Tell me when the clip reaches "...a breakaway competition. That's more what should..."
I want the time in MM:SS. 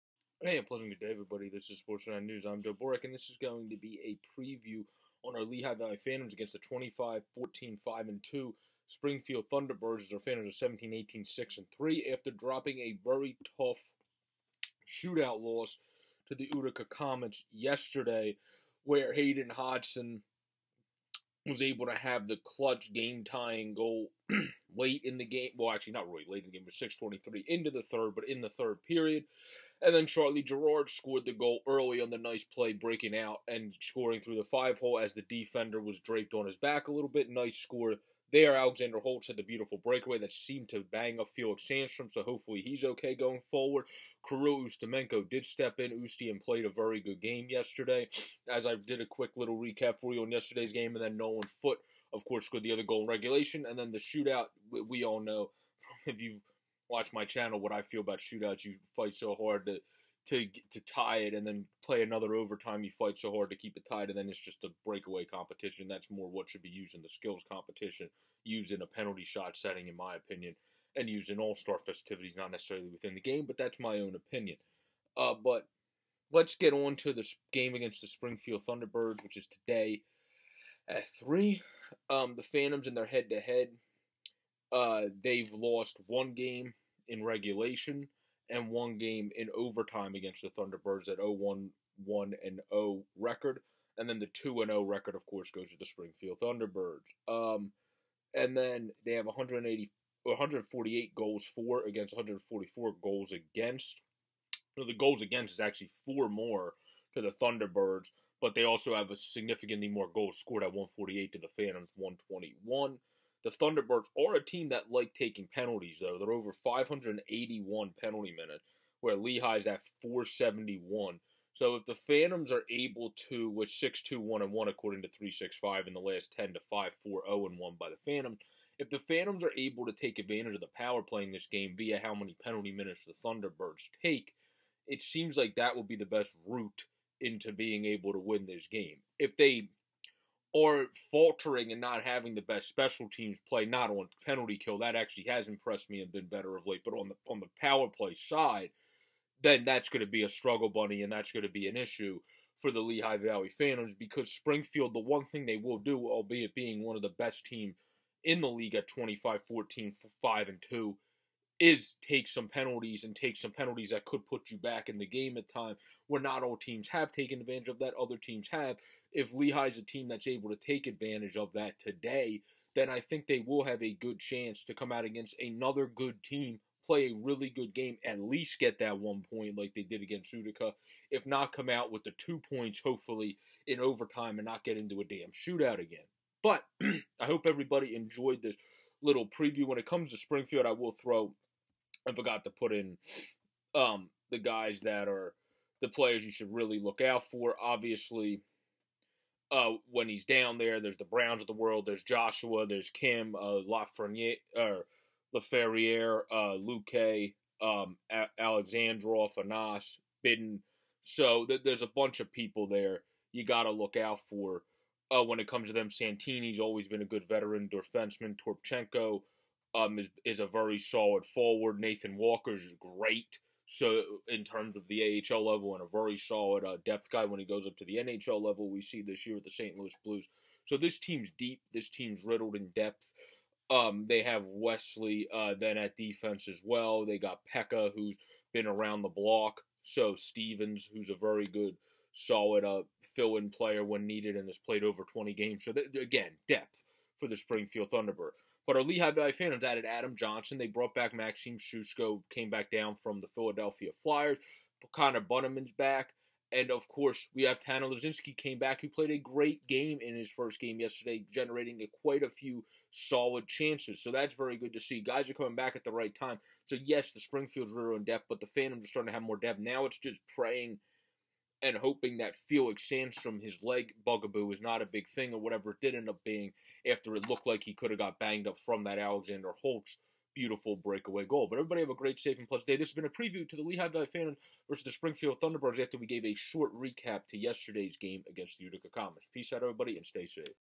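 01:04.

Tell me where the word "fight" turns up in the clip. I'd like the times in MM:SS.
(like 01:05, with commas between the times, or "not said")
00:58, 01:02.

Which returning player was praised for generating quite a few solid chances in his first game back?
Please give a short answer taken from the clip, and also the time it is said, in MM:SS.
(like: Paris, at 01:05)
Tanner Laczynski, at 04:17.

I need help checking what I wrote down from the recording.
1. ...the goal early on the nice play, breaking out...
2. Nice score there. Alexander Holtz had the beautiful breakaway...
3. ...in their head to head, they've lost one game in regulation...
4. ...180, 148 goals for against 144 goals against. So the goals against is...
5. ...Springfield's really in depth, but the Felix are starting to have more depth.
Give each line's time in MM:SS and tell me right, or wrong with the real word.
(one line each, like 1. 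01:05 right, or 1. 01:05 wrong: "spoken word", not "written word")
1. 00:31 right
2. 00:37 right
3. 01:22 right
4. 01:39 right
5. 04:27 wrong: "Phantoms", not "Felix".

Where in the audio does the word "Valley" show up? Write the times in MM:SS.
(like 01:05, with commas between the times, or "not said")
00:05, 02:33, 04:09, 04:43.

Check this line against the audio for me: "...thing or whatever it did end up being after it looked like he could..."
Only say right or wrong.
right.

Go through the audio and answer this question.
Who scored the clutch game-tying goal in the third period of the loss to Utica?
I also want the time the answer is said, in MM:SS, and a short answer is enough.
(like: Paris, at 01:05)
Hayden Hodgson, at 00:19.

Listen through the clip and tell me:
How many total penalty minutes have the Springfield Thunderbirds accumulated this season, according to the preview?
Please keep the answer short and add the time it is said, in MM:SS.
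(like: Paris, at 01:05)
581, at 01:56.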